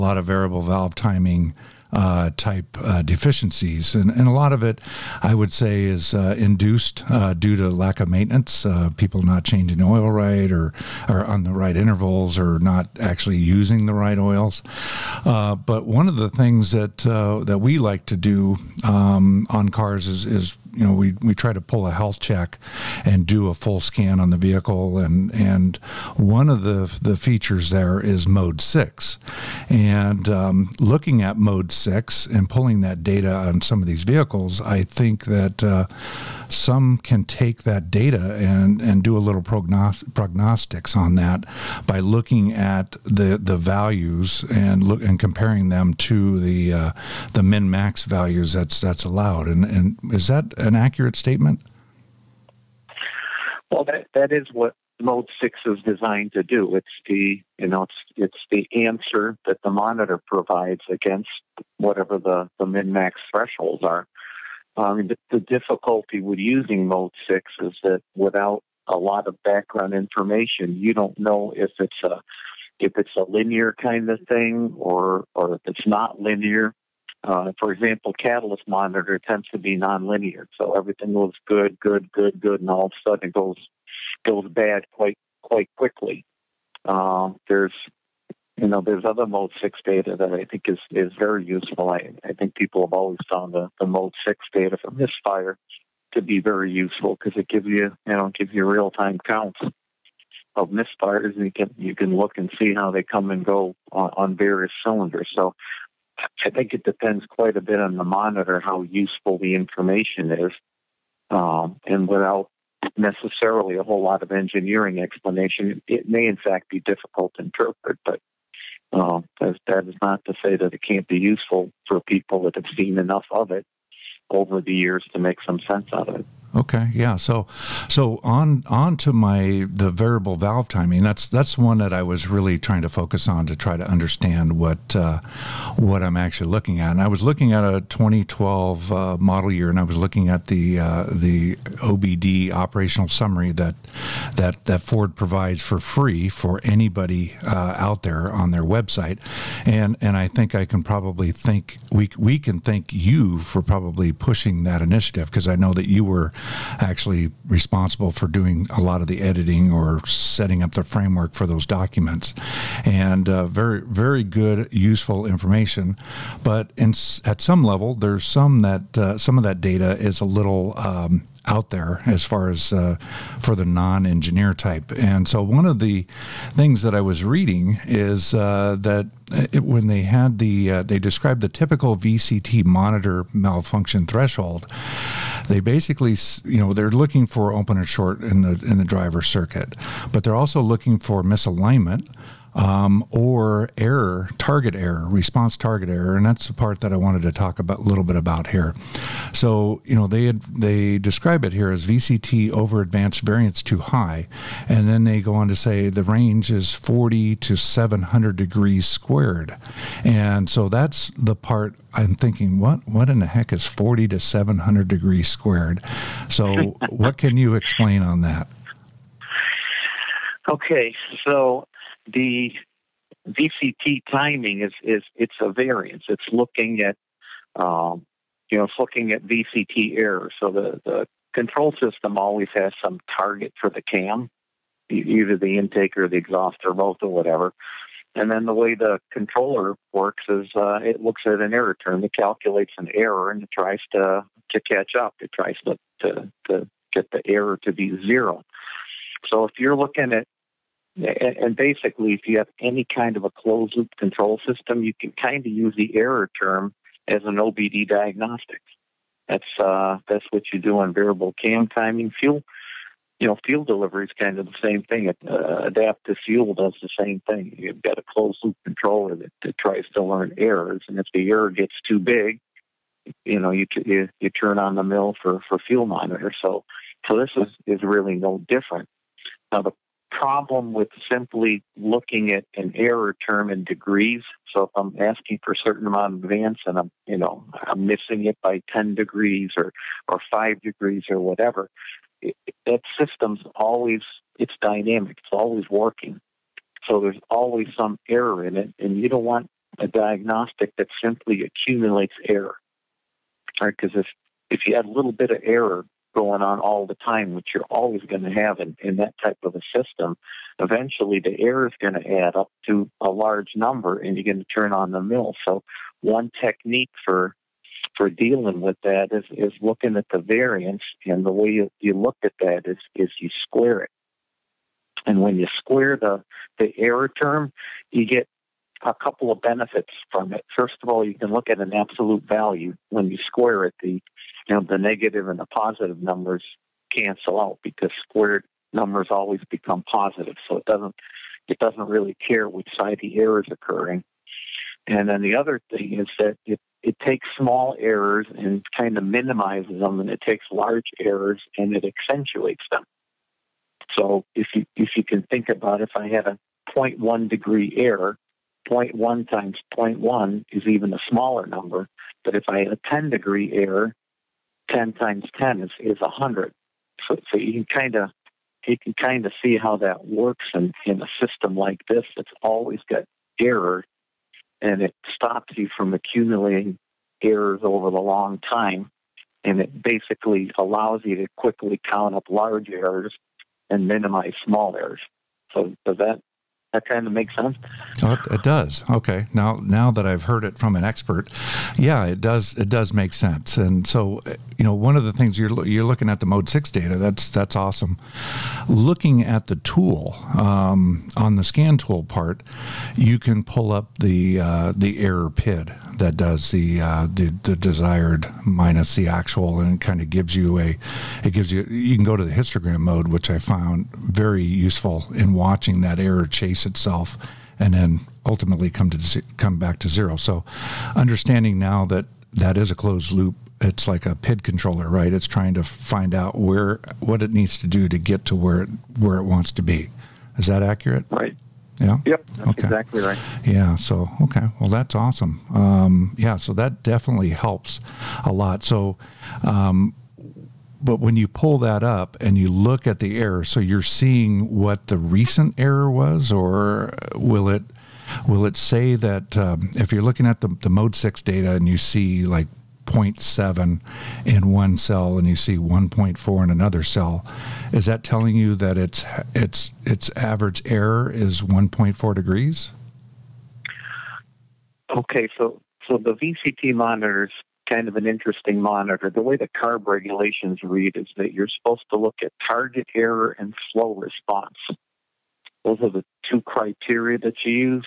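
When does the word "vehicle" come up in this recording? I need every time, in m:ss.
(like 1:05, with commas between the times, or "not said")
0:24, 0:34.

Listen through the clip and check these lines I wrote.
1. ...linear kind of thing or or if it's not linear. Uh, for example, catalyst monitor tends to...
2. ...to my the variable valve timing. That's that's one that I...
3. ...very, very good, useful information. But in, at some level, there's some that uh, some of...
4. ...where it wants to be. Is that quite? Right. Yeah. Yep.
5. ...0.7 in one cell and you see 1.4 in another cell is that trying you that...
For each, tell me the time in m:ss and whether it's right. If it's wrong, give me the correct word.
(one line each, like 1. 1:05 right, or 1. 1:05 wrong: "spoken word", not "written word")
1. 1:13 right
2. 2:08 right
3. 2:43 right
4. 7:08 wrong: "accurate", not "quite"
5. 7:32 wrong: "telling", not "trying".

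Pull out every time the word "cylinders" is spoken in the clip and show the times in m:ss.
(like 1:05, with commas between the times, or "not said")
1:44.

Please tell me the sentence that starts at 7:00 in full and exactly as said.
So understanding now that that is a closed loop it's like a PID controller, right?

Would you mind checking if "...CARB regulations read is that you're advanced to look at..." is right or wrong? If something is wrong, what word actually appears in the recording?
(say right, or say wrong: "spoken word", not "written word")
wrong: "supposed", not "advanced".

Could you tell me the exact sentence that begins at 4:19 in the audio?
That's uh, that's what you do on variable cam timing.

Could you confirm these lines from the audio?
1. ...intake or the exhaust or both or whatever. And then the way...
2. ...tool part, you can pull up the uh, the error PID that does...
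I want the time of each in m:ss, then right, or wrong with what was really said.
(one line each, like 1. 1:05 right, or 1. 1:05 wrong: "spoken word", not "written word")
1. 3:55 right
2. 6:41 right.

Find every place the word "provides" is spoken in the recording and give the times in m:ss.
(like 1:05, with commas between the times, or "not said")
1:00, 2:25.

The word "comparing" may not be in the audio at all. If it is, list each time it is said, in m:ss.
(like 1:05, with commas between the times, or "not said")
0:45.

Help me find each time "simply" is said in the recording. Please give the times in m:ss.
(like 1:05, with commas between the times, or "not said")
4:41, 5:01.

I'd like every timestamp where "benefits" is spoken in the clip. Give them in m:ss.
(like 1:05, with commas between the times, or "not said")
5:29.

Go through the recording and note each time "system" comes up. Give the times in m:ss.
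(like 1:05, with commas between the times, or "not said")
3:51, 4:14, 4:52, 5:09, 6:11.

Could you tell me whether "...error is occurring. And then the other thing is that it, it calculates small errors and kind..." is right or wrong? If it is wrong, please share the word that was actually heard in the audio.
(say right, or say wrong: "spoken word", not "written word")
wrong: "takes", not "calculates".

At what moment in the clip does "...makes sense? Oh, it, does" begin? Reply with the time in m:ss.
6:27.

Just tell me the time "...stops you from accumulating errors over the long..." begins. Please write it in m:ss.
6:15.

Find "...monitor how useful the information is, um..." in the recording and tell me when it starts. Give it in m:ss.
1:48.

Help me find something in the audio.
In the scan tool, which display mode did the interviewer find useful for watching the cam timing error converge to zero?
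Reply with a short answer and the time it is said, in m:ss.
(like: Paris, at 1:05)
Histogram mode, at 6:52.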